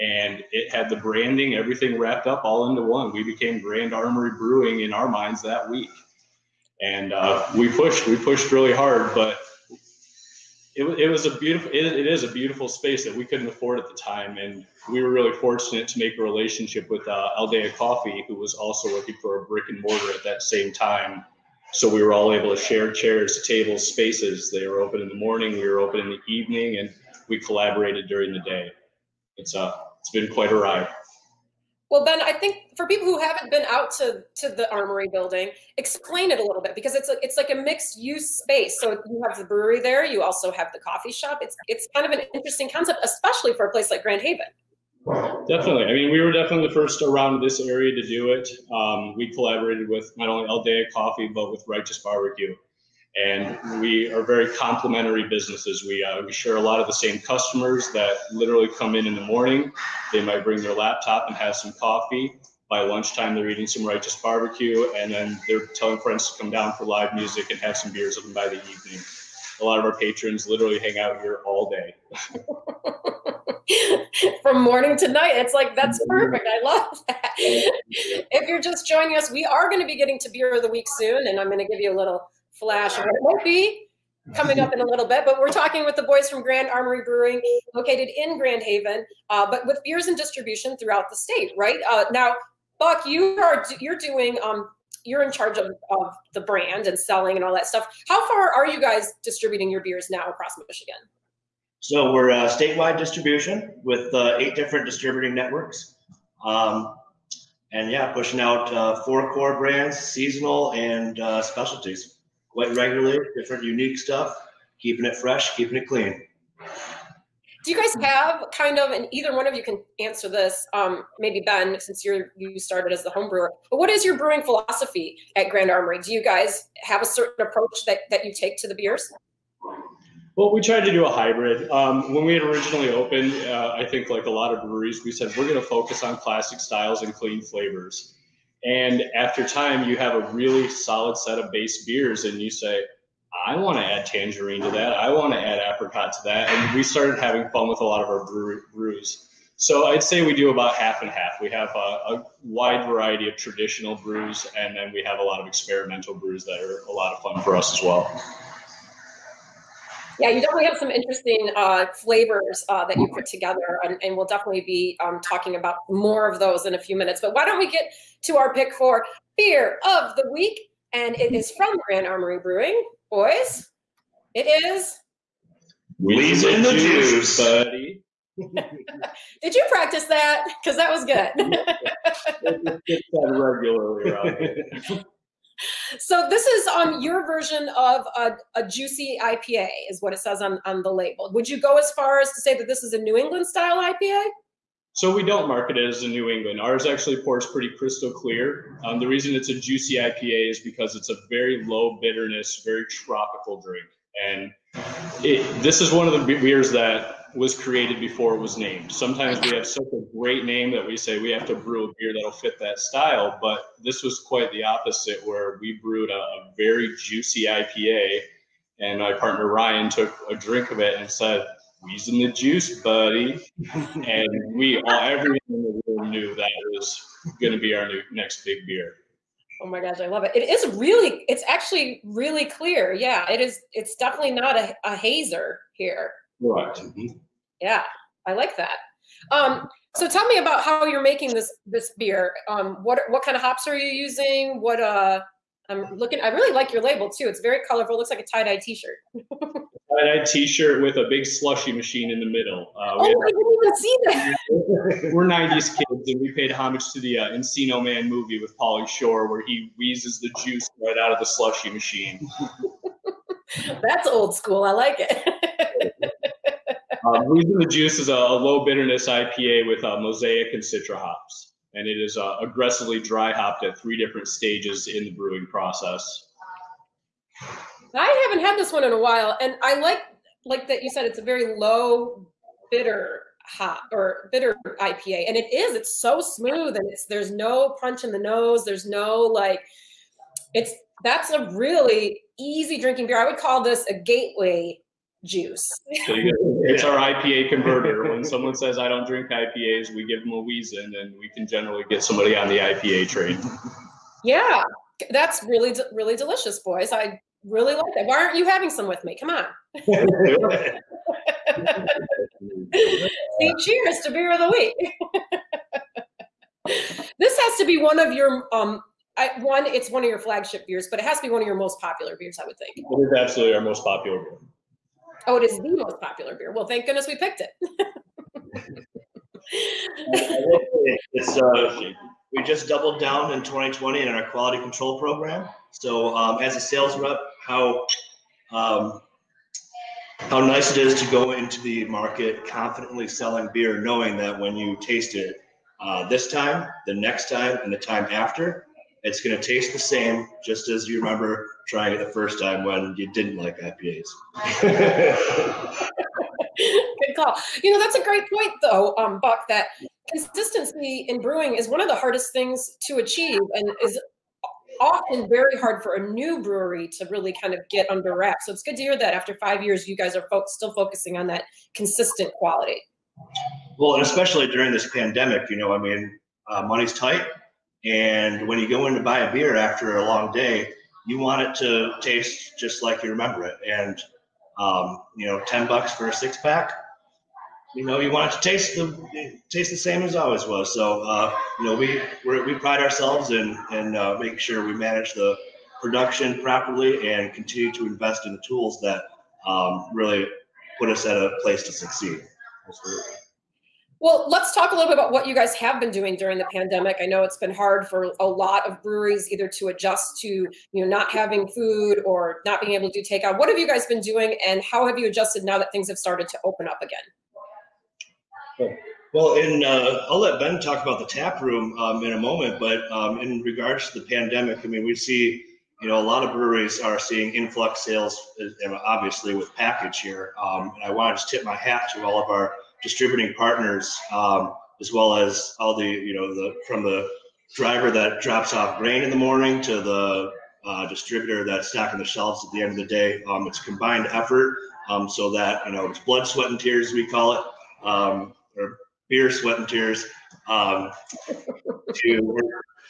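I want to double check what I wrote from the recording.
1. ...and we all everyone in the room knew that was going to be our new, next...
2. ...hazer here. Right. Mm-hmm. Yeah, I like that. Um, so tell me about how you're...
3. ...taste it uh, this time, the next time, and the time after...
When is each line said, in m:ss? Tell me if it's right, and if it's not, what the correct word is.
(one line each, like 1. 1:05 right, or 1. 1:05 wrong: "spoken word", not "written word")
1. 3:43 right
2. 3:54 right
3. 5:44 right.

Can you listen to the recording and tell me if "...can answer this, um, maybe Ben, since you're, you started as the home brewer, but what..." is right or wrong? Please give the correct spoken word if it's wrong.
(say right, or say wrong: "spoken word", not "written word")
right.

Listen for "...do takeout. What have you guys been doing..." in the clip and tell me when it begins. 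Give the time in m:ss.
6:53.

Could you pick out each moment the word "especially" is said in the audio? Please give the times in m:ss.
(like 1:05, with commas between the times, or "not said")
0:43, 6:14.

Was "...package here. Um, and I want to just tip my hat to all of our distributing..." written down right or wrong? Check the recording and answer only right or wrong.
right.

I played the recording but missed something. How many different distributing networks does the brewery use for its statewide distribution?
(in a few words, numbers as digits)
8.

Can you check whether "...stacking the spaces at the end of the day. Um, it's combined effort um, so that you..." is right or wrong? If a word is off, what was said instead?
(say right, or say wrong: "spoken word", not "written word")
wrong: "shelves", not "spaces".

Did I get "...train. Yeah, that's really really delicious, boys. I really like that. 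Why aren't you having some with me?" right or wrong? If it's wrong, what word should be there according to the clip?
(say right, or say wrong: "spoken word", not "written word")
right.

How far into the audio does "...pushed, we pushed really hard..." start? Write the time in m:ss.
0:07.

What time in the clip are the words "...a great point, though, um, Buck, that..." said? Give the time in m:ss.
5:57.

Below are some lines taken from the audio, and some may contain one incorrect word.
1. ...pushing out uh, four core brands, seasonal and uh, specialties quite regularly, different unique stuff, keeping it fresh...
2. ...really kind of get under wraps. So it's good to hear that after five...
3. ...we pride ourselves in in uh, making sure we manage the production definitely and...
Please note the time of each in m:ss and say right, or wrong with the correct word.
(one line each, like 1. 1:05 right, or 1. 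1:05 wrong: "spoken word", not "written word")
1. 1:48 right
2. 6:07 right
3. 6:32 wrong: "properly", not "definitely".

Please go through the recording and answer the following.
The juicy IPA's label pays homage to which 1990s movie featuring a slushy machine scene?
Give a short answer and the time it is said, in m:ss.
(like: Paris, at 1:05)
Encino Man, at 4:17.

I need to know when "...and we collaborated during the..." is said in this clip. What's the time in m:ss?
0:26.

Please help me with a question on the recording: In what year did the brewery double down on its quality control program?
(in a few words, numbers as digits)
2020.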